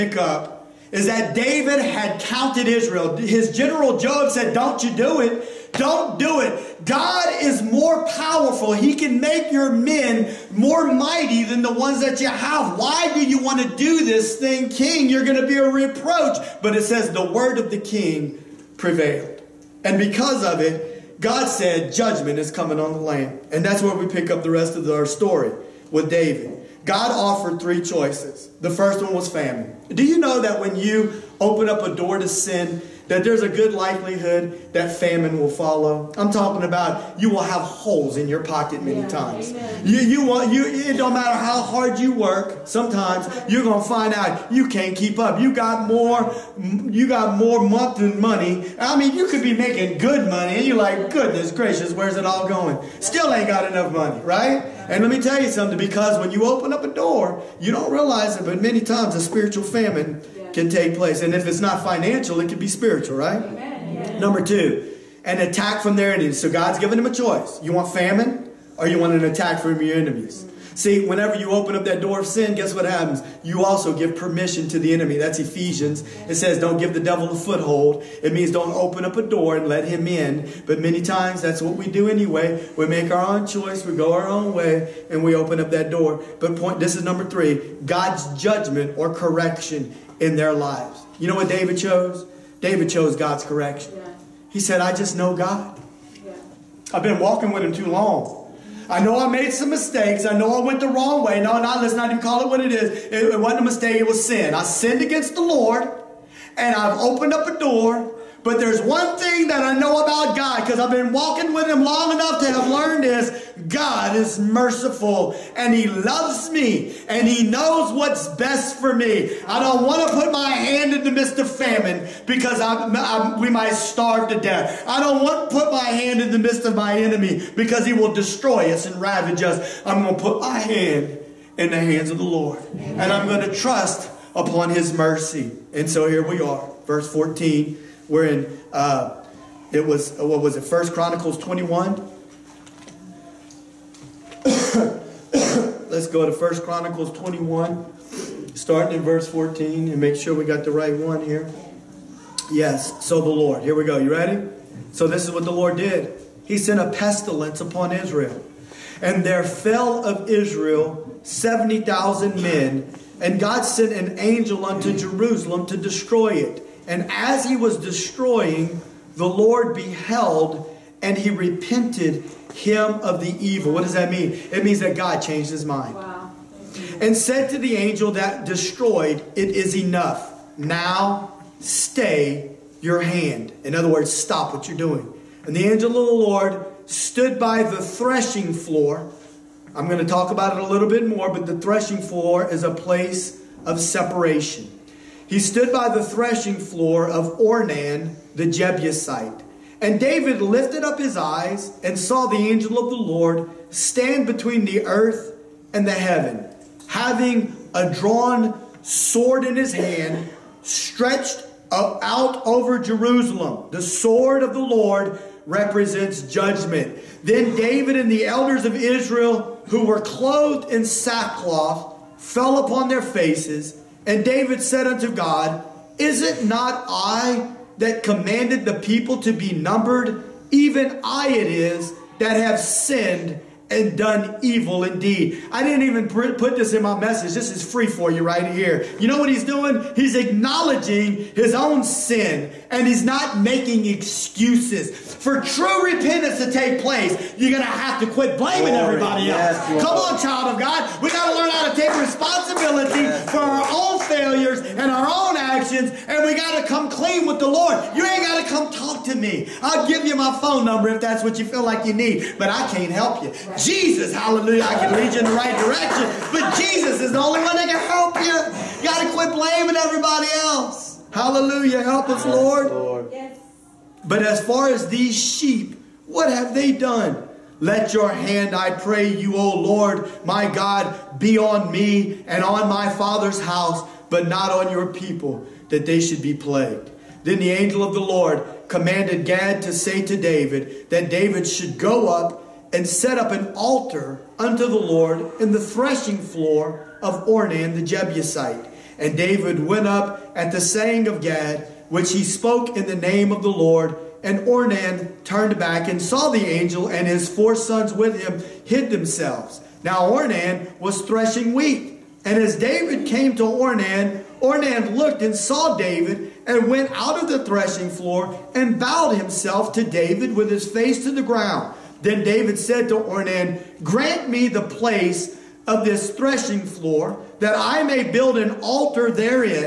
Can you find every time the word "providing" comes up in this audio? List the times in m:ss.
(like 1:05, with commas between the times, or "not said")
not said.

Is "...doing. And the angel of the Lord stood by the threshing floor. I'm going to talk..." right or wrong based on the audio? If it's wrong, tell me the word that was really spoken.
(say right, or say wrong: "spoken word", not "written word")
right.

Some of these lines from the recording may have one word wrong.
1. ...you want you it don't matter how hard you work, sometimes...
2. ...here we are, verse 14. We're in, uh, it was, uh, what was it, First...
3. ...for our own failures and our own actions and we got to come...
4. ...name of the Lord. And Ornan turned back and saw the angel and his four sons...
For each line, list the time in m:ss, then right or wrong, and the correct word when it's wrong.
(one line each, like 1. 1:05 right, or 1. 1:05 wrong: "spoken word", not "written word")
1. 0:39 right
2. 2:16 right
3. 4:13 right
4. 5:02 right.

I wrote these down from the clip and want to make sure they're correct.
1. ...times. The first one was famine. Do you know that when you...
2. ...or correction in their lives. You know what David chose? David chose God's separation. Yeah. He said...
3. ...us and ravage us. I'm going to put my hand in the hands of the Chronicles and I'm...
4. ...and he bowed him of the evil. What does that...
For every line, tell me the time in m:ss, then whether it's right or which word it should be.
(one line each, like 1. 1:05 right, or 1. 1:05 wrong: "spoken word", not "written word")
1. 0:27 wrong: "choices", not "times"
2. 1:28 wrong: "correction", not "separation"
3. 2:08 wrong: "Lord", not "Chronicles"
4. 2:51 wrong: "repented", not "bowed".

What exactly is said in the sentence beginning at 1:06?
So God's given them a choice.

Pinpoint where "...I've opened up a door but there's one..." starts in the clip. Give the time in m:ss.
1:46.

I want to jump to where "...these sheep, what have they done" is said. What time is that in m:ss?
4:34.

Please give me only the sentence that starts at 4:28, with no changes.
You got to quit blaming everybody else.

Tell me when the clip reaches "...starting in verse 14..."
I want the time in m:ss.
2:28.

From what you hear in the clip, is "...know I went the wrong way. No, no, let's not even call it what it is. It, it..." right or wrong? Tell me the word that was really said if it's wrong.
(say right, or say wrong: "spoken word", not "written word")
right.